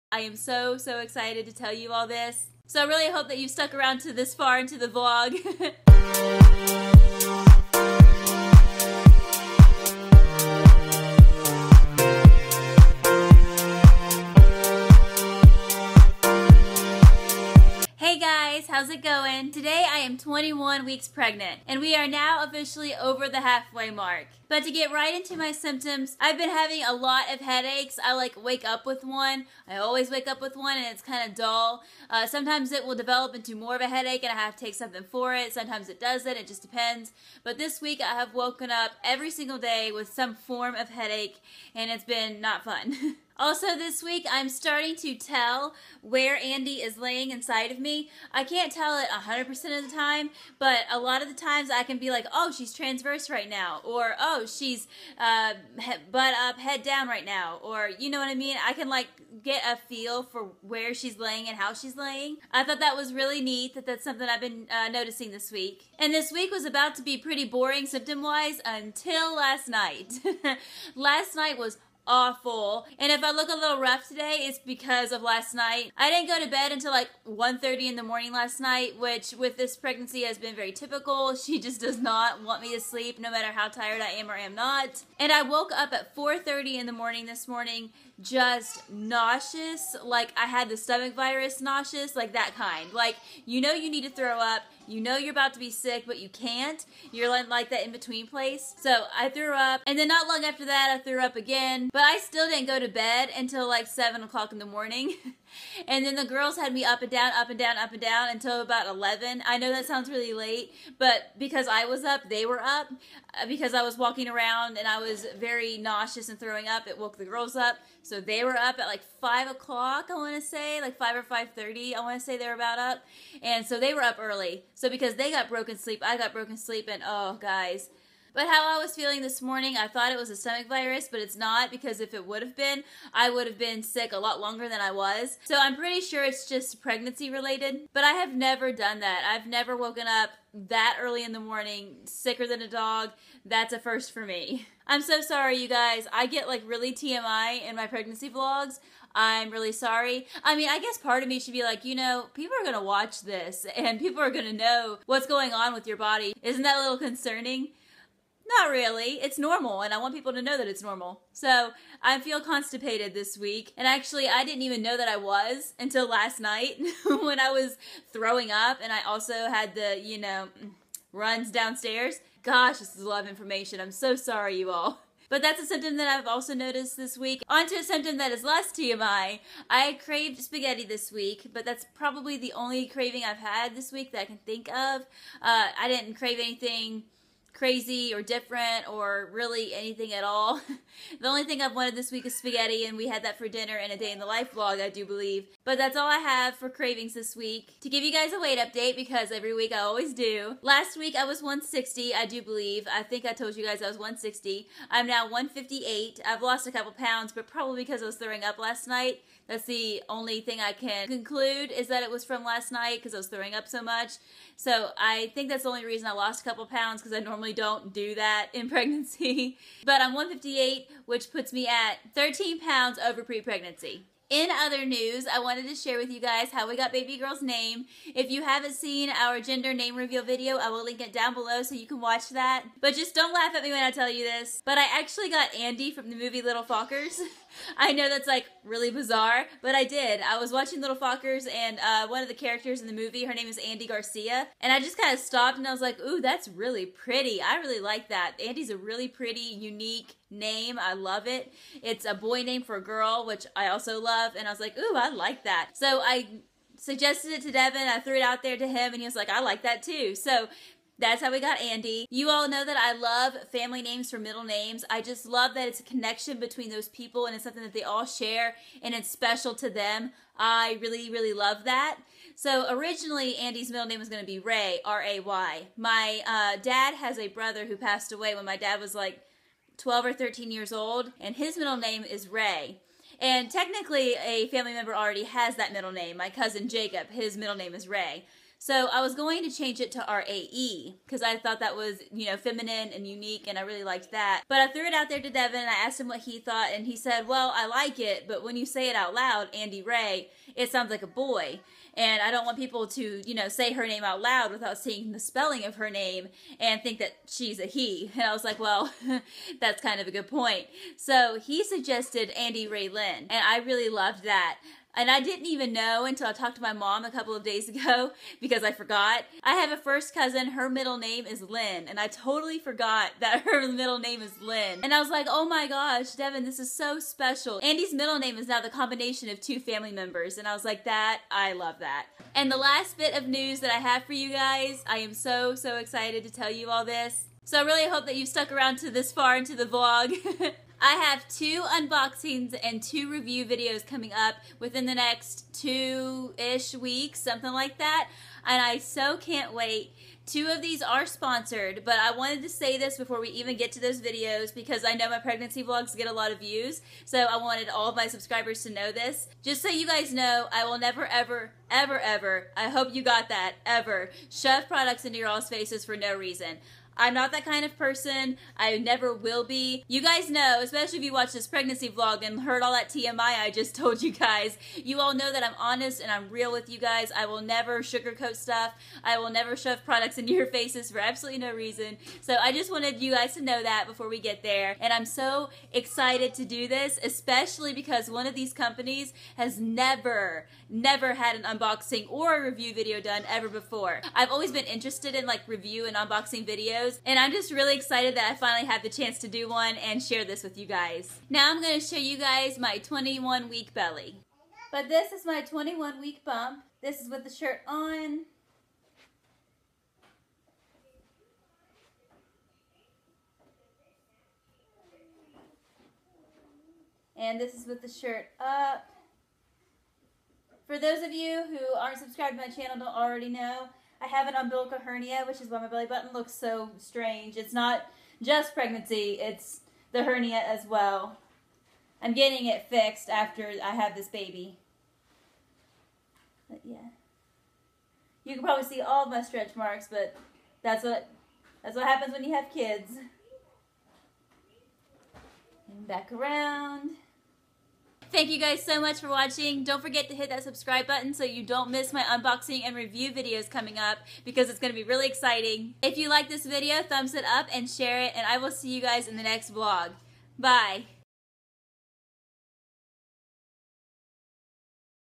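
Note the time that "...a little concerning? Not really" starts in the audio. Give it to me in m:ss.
2:36.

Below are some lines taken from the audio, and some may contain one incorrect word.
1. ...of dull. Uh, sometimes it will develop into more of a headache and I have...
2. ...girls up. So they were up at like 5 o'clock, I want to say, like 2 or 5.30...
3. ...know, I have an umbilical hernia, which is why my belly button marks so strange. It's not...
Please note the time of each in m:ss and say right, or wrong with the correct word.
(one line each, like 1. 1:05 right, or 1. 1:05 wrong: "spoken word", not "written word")
1. 0:31 right
2. 1:57 wrong: "5", not "2"
3. 7:03 wrong: "looks", not "marks".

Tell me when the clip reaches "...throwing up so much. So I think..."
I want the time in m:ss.
3:33.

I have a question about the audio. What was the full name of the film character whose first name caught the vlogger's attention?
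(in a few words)
Andy Garcia.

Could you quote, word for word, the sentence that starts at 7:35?
If you like this video, thumbs it up and share it, and I will see you guys in the next vlog.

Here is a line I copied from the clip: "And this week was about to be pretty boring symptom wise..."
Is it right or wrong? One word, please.
right.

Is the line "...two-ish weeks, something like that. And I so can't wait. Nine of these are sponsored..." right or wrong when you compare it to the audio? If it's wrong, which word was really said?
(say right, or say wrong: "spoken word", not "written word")
wrong: "Two", not "Nine".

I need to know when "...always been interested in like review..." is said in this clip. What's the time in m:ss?
6:34.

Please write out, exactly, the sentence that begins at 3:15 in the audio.
But that's all I have for cravings this week.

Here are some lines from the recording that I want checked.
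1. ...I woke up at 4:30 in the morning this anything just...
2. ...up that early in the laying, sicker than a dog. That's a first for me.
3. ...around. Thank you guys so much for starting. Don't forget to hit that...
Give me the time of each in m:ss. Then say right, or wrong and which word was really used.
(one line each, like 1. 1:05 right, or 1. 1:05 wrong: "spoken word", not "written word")
1. 1:25 wrong: "morning", not "anything"
2. 2:20 wrong: "morning", not "laying"
3. 7:26 wrong: "watching", not "starting".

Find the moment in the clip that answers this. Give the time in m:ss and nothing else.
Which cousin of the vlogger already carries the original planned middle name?
4:46.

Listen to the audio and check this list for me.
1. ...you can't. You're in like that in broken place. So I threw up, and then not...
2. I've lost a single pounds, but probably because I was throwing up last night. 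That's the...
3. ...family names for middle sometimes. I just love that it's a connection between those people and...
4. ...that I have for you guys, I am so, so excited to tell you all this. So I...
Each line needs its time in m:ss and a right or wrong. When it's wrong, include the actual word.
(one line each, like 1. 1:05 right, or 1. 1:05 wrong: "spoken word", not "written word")
1. 1:36 wrong: "between", not "broken"
2. 3:26 wrong: "couple", not "single"
3. 4:23 wrong: "names", not "sometimes"
4. 5:33 right.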